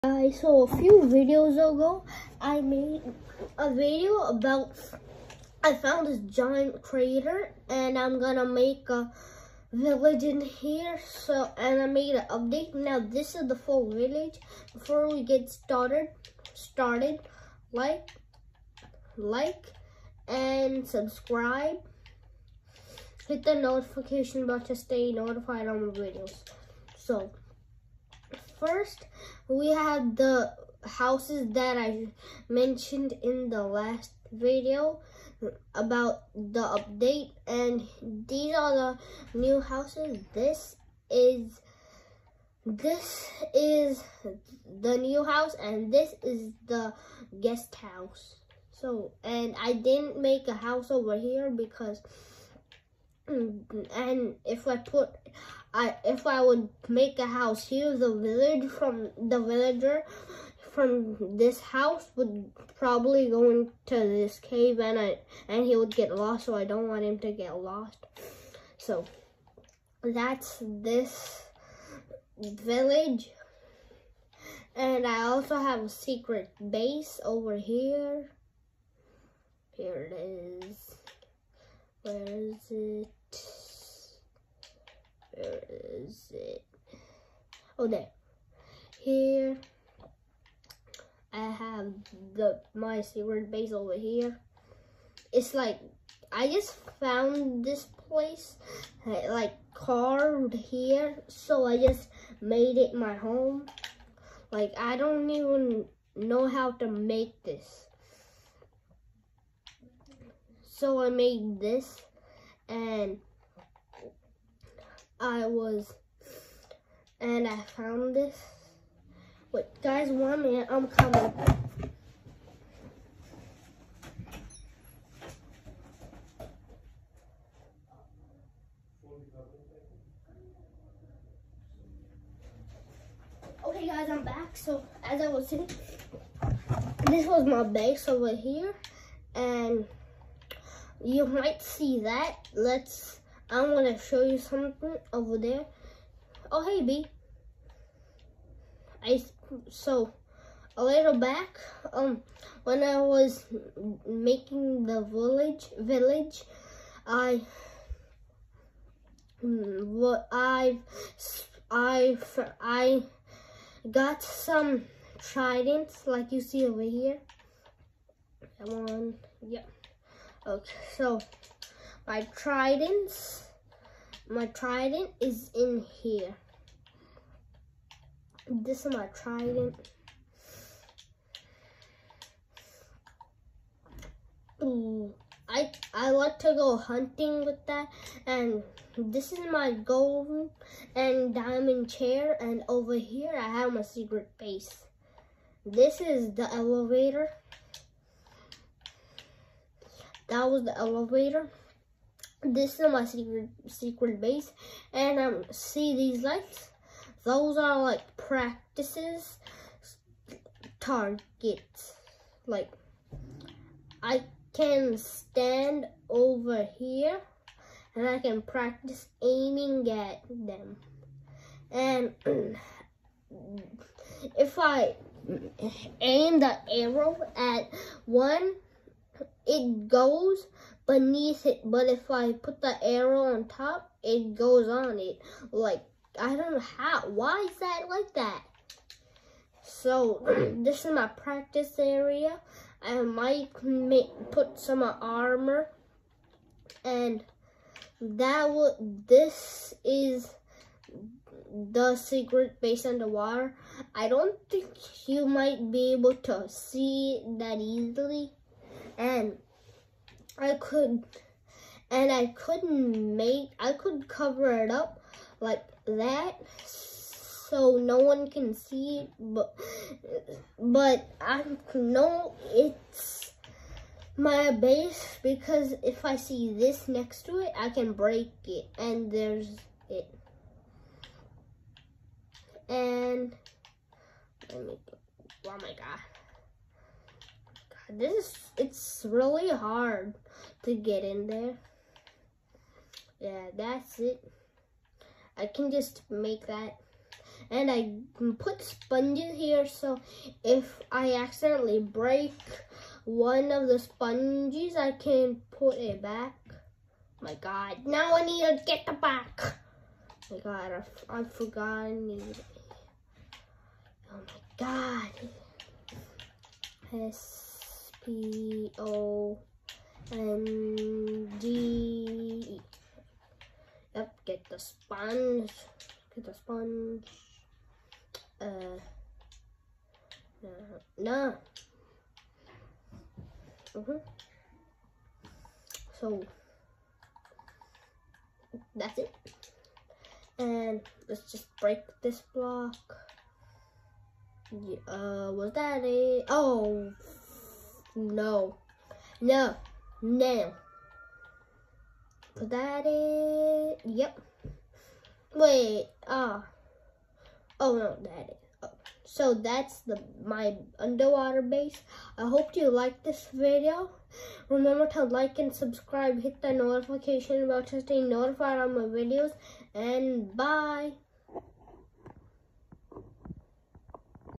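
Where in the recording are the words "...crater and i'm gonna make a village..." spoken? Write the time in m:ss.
0:06.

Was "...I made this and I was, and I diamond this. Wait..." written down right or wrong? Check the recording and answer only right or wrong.
wrong.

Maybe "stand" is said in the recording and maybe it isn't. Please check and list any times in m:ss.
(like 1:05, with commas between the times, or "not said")
3:34.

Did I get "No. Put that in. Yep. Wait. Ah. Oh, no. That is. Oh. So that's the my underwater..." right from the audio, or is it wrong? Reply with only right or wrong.
right.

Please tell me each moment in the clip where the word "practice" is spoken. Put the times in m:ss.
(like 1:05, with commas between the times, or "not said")
3:28, 3:38, 4:01.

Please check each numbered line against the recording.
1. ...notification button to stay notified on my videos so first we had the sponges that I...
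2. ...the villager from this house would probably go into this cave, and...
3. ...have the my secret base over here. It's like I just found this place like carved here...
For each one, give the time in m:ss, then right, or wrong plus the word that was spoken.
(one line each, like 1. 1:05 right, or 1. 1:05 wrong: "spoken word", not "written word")
1. 0:23 wrong: "houses", not "sponges"
2. 0:59 right
3. 1:31 right.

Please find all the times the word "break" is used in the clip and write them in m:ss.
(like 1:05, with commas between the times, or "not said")
4:37, 5:01, 5:41.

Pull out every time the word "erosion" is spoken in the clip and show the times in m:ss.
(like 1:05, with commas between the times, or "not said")
not said.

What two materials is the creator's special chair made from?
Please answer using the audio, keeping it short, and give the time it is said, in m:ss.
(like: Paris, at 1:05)
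Gold and diamond, at 3:09.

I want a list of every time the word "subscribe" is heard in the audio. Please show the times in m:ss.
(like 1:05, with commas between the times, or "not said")
0:20, 6:05.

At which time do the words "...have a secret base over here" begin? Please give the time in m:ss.
1:15.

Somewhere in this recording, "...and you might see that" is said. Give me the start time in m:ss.
2:19.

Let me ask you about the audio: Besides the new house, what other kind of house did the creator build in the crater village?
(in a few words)
Guest house.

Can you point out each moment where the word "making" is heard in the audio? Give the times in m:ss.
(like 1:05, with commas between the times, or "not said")
2:34.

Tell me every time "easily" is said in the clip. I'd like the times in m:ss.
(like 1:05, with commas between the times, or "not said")
4:17.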